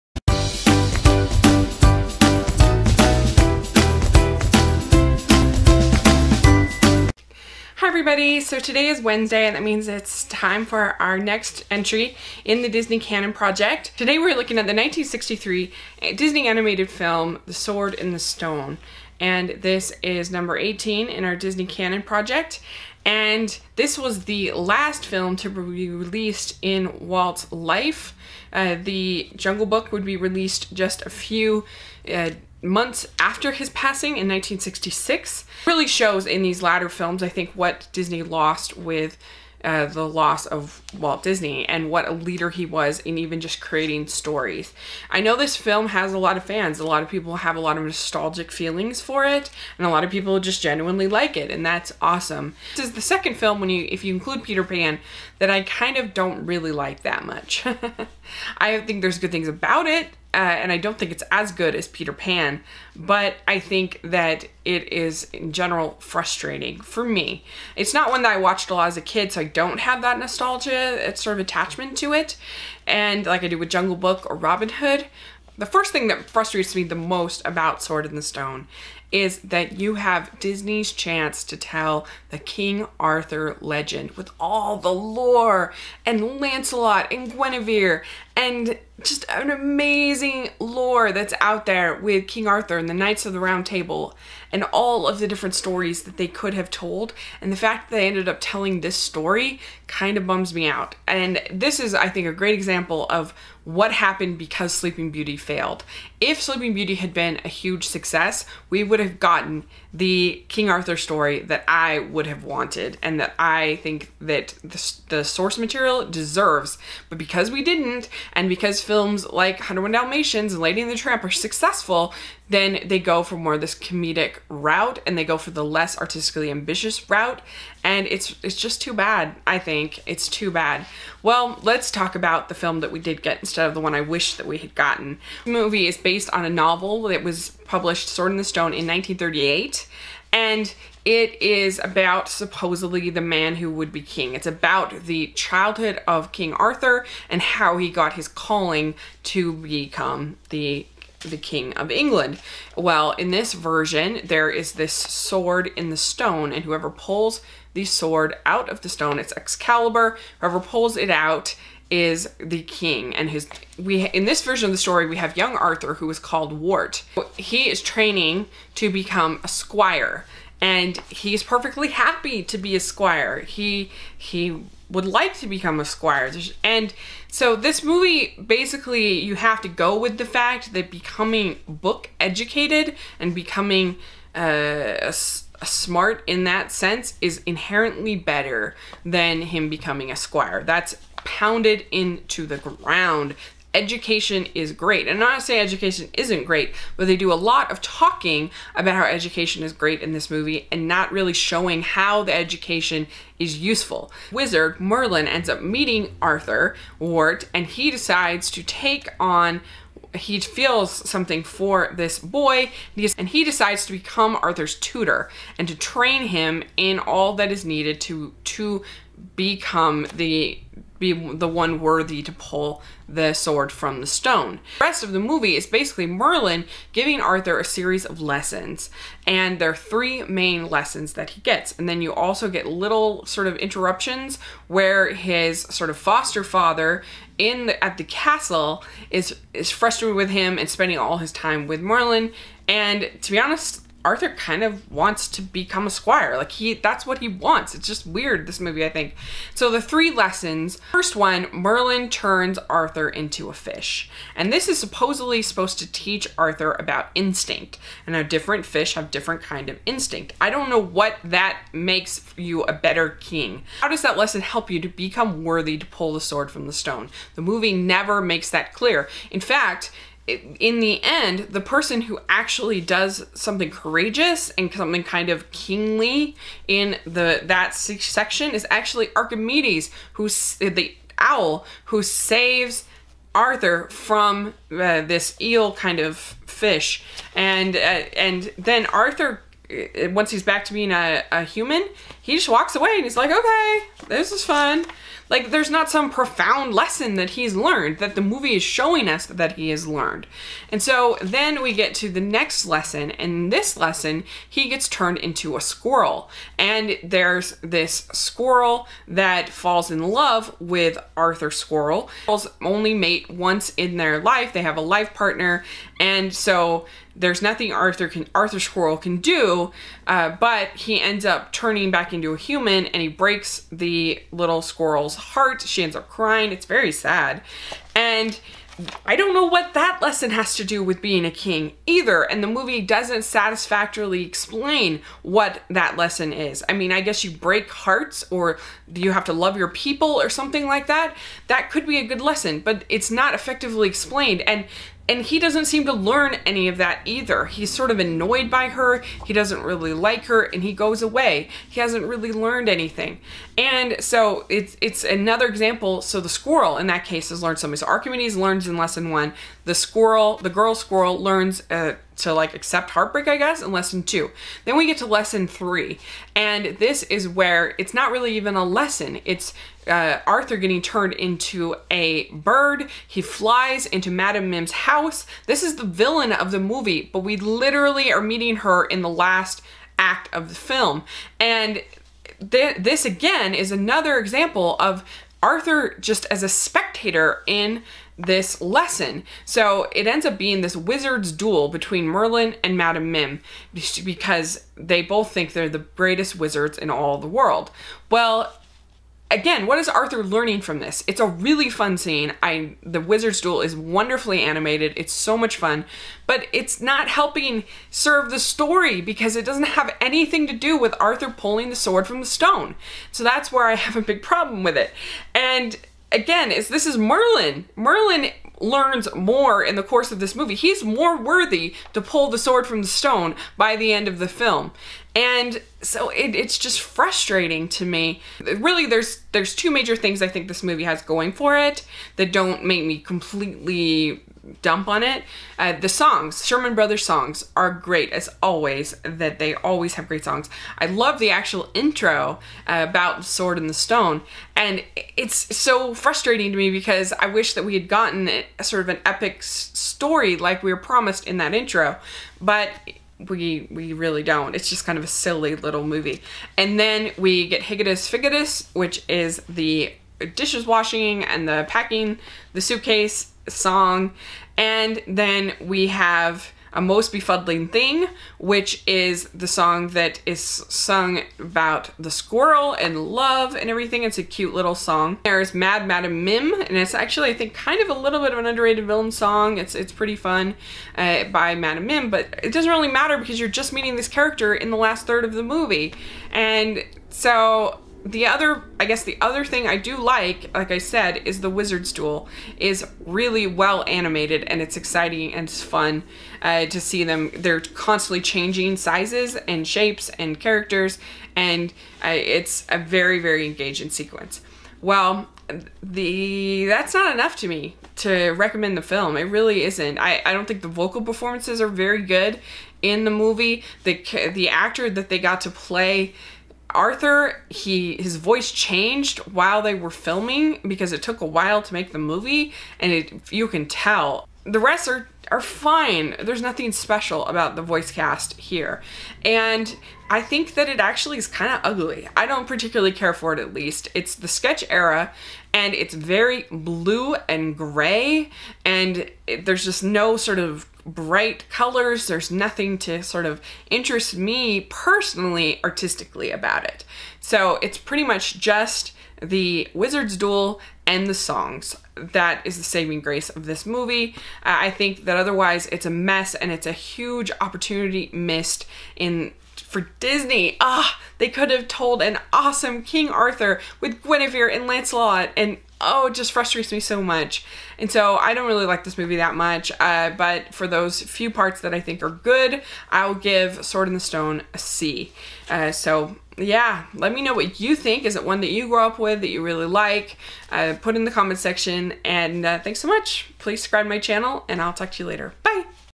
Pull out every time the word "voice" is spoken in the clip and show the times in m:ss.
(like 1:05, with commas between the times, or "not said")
8:38, 8:47.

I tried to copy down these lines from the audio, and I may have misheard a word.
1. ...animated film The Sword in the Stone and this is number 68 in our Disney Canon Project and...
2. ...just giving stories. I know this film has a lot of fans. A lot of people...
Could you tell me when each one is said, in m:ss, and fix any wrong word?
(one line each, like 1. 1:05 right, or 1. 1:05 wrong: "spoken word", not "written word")
1. 0:16 wrong: "18", not "68"
2. 0:43 wrong: "creating", not "giving".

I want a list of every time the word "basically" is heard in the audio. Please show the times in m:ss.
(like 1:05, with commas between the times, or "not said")
2:58, 3:45.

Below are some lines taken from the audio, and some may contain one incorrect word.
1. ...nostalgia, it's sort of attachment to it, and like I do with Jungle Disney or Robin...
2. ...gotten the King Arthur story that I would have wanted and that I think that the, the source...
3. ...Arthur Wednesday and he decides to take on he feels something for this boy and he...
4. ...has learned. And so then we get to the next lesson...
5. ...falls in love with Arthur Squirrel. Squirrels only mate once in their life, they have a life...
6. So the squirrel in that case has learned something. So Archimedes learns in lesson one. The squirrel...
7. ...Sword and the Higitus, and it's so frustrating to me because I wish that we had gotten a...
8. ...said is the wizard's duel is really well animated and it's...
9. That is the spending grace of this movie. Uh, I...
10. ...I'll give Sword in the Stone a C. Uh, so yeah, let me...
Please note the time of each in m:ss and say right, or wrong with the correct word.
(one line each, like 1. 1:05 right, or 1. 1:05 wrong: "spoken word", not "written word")
1. 1:10 wrong: "Book", not "Disney"
2. 1:49 right
3. 3:26 wrong: "Wart", not "Wednesday"
4. 4:59 right
5. 5:09 right
6. 5:56 right
7. 7:23 wrong: "Stone", not "Higitus"
8. 8:10 right
9. 9:11 wrong: "saving", not "spending"
10. 9:32 right.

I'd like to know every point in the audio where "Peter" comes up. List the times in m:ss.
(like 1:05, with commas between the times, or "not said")
0:54, 1:01.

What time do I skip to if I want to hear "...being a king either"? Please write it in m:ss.
5:31.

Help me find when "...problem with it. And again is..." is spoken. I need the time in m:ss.
6:54.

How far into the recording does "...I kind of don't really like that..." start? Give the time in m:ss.
0:55.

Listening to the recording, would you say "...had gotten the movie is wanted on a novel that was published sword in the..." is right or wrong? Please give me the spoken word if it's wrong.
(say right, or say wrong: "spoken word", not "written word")
wrong: "based", not "wanted".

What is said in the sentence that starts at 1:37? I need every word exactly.
And the fact that they ended up telling this story kind of bums me out.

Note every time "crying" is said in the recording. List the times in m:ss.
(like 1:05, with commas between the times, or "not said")
5:26.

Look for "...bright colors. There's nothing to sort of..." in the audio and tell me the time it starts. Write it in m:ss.
9:00.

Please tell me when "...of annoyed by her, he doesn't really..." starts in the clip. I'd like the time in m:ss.
5:47.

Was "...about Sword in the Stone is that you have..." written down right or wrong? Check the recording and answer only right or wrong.
right.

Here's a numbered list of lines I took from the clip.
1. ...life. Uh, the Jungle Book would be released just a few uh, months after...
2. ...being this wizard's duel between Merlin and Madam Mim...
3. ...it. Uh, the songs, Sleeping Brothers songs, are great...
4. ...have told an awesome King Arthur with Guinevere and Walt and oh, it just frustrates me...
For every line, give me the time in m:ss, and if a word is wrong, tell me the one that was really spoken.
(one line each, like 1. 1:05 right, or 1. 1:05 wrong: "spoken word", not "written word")
1. 0:27 right
2. 6:30 right
3. 7:15 wrong: "Sherman", not "Sleeping"
4. 9:21 wrong: "Lancelot", not "Walt".